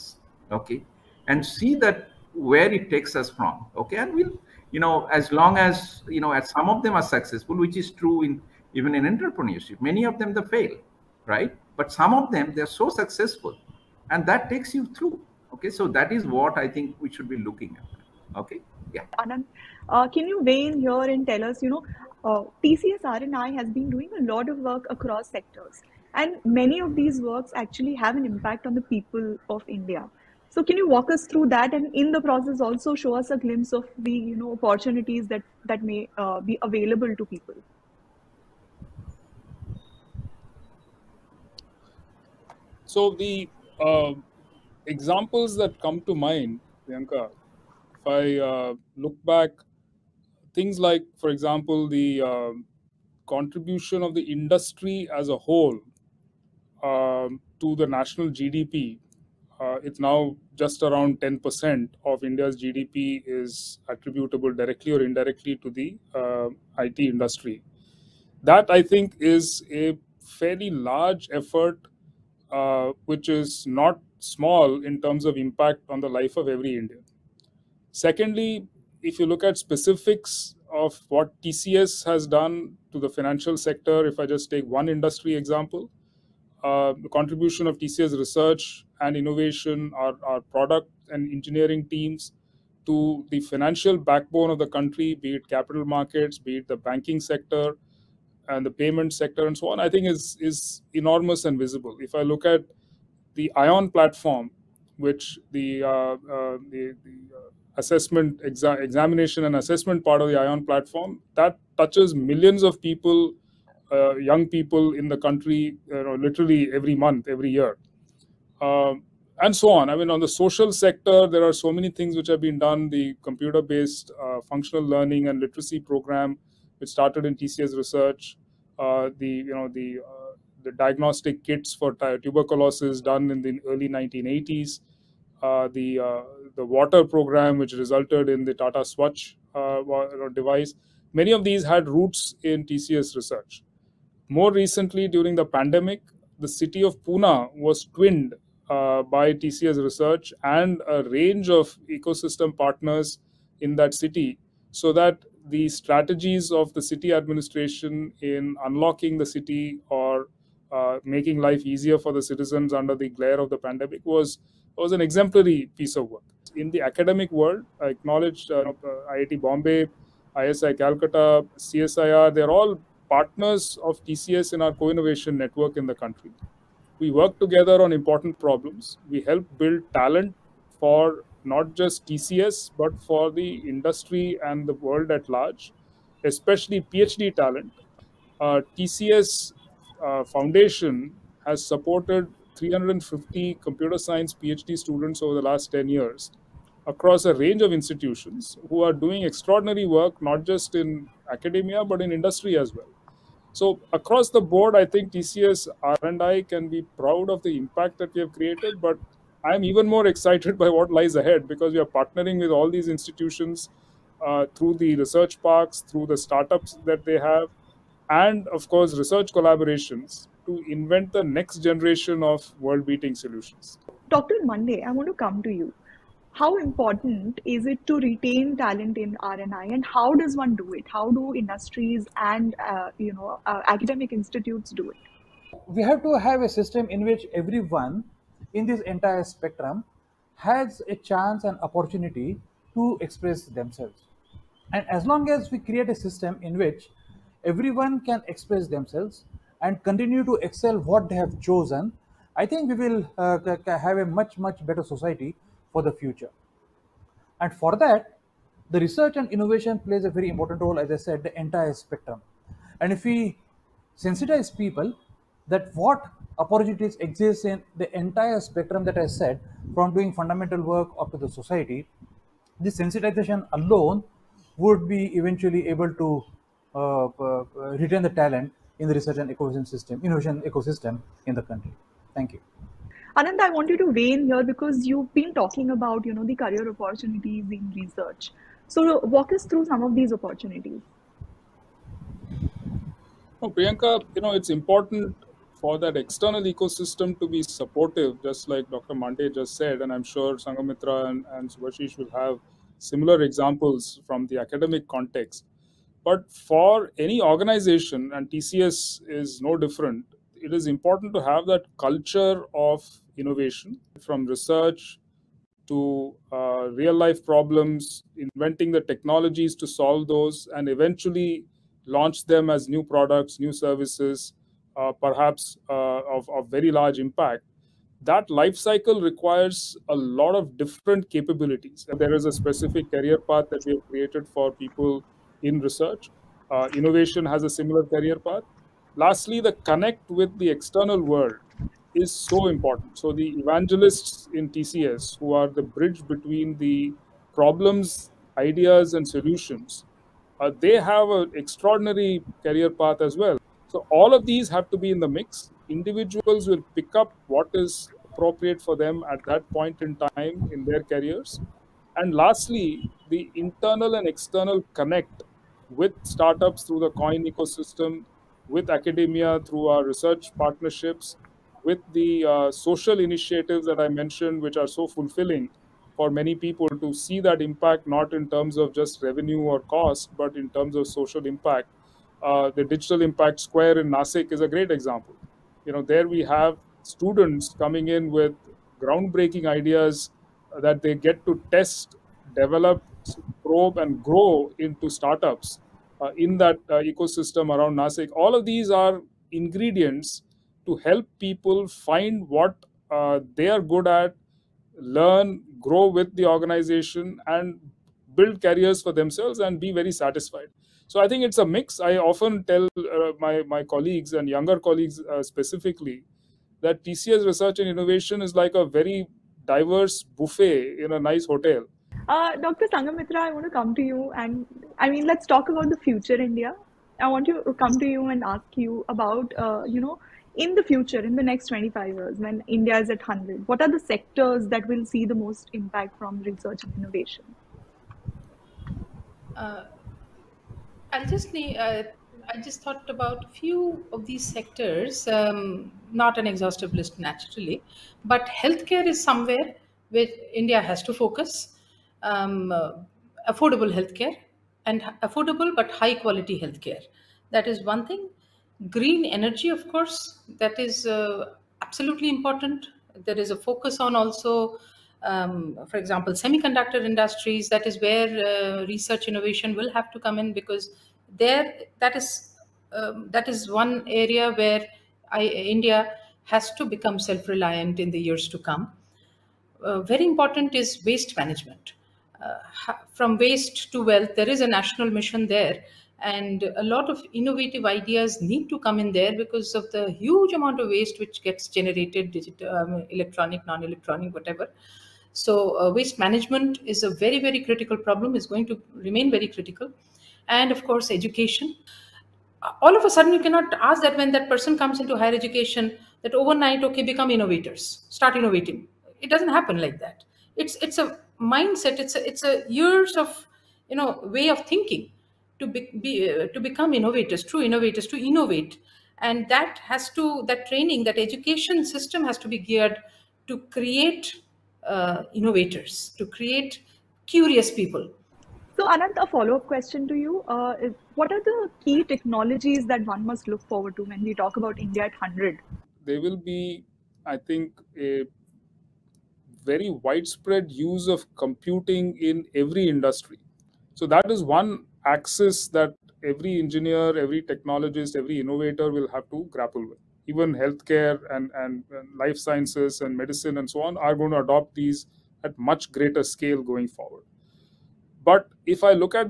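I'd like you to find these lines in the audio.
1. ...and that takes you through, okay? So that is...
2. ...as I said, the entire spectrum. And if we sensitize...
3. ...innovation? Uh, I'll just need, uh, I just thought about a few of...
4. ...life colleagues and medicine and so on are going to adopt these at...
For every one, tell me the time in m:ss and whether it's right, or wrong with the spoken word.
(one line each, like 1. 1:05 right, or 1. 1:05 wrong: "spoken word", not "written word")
1. 0:14 right
2. 4:20 right
3. 7:16 right
4. 9:11 wrong: "sciences", not "colleagues".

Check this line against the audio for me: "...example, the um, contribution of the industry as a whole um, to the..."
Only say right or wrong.
right.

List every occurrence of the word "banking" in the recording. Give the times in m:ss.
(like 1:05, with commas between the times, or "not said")
1:36.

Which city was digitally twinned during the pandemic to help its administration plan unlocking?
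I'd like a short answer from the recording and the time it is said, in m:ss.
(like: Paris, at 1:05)
Pune, at 2:27.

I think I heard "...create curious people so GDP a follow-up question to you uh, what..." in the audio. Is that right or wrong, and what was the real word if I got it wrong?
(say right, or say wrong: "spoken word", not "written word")
wrong: "Ananth", not "GDP".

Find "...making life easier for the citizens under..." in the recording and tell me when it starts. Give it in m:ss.
2:41.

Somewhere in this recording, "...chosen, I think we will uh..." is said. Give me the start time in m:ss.
4:11.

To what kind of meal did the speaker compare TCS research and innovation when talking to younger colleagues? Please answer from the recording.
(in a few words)
buffet.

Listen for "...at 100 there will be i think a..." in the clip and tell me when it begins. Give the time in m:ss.
8:54.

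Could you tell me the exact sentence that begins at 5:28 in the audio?
That life cycle requires a lot of different capabilities.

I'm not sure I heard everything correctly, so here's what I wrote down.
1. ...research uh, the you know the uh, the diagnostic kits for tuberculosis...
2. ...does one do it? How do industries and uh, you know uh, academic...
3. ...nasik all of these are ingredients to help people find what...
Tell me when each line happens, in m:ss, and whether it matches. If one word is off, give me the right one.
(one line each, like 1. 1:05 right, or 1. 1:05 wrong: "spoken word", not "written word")
1. 2:07 right
2. 3:50 right
3. 6:37 right.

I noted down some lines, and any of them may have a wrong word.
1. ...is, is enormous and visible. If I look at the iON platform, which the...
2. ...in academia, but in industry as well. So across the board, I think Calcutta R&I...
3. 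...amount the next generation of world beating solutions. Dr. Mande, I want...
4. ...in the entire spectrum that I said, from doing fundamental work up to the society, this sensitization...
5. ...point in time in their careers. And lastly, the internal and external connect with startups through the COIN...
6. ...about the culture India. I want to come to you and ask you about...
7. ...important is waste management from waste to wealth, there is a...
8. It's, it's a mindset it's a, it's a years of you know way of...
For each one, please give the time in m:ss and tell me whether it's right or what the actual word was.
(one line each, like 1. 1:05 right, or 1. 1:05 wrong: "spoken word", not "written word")
1. 1:40 right
2. 3:20 wrong: "TCS", not "Calcutta"
3. 3:40 wrong: "invent", not "amount"
4. 4:27 right
5. 5:59 right
6. 7:05 wrong: "future", not "culture"
7. 8:00 right
8. 8:30 right.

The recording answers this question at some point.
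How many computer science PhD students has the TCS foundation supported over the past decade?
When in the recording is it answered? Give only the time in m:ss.
3:12.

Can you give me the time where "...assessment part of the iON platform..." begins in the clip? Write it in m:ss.
1:49.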